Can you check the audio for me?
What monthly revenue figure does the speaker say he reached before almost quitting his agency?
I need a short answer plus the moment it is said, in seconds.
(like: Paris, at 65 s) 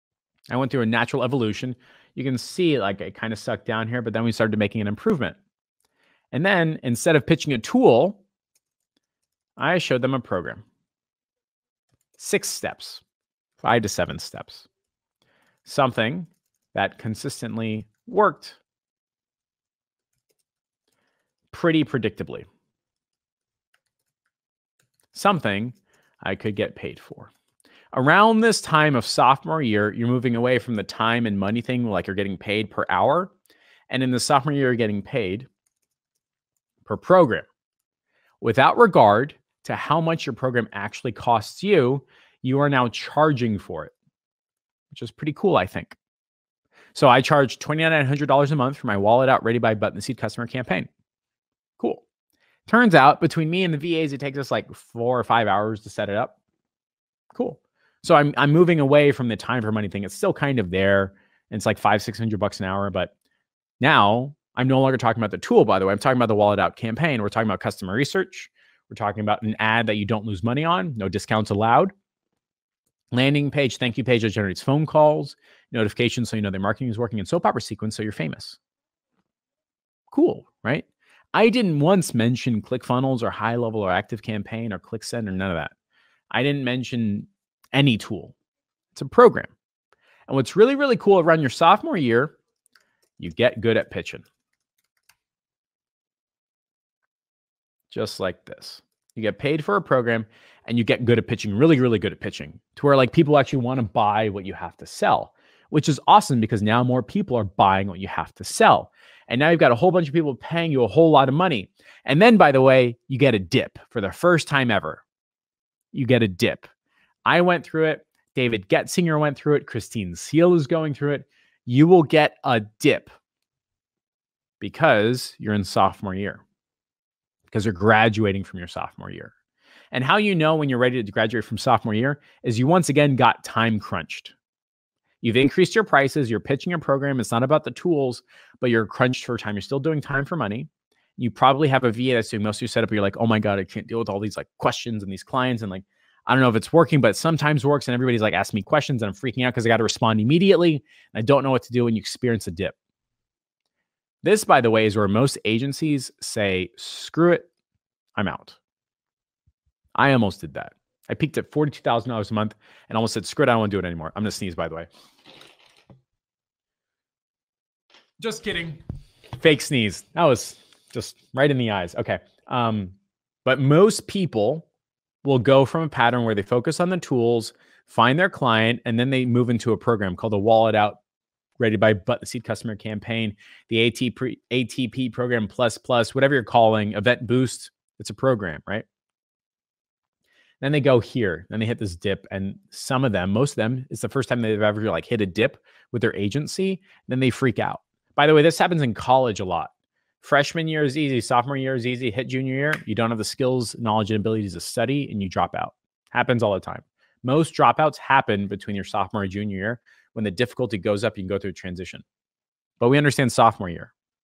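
$42,000, at 161 s.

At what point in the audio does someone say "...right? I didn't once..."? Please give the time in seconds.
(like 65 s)
80 s.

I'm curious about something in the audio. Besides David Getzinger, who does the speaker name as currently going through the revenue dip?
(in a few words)
Christine Seal.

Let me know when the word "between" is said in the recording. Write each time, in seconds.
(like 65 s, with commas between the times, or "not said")
53 s, 208 s.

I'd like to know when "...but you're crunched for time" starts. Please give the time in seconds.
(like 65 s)
138 s.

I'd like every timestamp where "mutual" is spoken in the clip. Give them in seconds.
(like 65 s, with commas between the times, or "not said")
not said.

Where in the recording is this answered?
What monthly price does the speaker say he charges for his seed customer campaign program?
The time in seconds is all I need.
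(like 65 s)
47 s.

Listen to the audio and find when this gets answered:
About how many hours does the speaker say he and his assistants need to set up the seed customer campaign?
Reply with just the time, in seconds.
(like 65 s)
54 s.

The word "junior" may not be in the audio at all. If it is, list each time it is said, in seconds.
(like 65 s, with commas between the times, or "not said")
202 s, 209 s.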